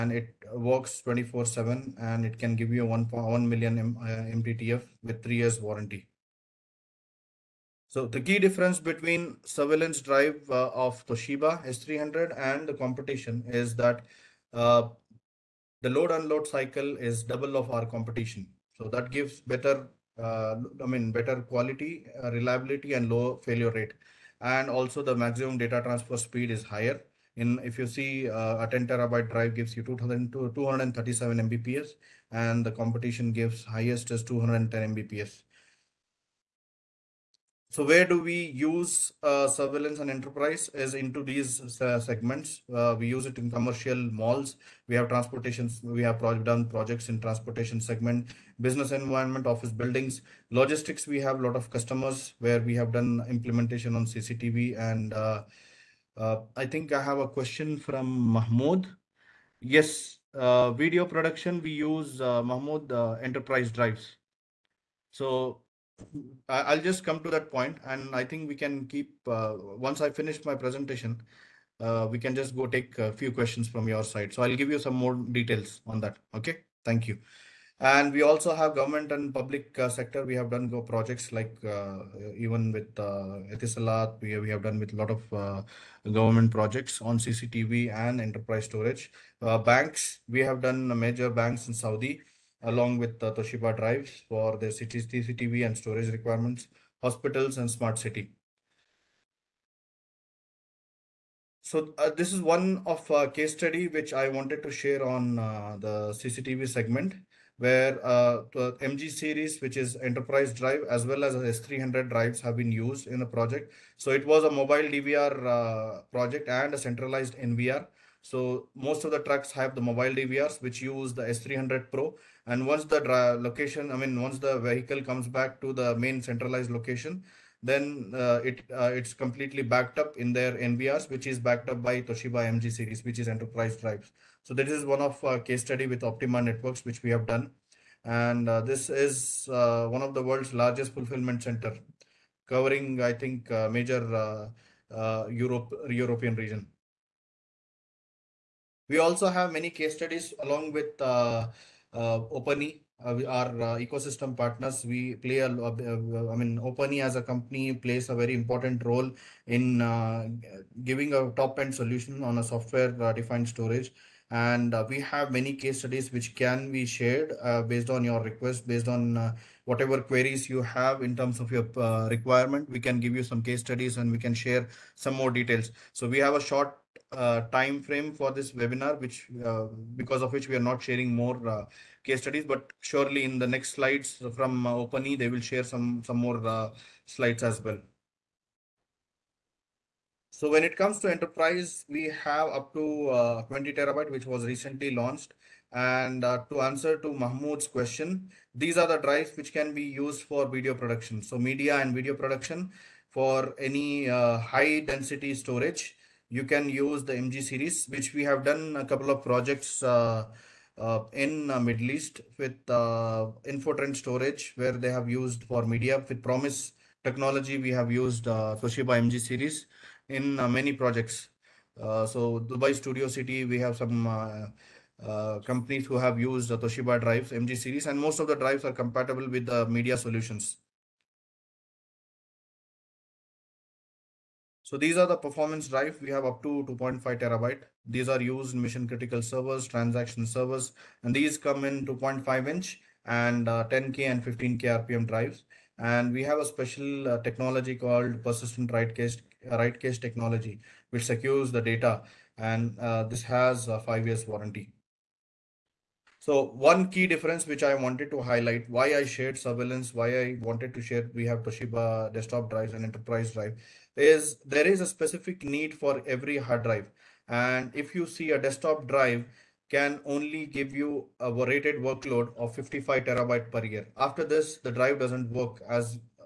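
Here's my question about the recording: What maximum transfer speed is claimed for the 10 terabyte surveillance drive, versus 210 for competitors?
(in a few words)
237 MBps.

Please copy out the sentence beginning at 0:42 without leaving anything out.
Uh, we use it in commercial malls.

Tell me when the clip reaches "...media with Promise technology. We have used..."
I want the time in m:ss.
3:35.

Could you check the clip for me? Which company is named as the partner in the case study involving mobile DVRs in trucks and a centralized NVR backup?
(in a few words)
Optima Networks.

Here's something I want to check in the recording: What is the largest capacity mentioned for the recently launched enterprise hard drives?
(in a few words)
20 terabytes.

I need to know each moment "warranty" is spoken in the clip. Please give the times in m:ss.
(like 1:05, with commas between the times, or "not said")
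0:05, 4:14.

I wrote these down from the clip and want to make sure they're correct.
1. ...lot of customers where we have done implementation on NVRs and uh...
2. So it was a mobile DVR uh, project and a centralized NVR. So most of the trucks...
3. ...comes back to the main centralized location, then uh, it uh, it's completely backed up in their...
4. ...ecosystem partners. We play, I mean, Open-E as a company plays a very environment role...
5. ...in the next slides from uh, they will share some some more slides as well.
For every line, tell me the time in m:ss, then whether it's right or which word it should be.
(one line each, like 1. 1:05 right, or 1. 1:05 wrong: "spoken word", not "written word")
1. 0:51 wrong: "CCTV", not "NVRs"
2. 1:53 right
3. 2:05 right
4. 2:33 wrong: "important", not "environment"
5. 3:03 right.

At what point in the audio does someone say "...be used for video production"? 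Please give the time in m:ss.
3:19.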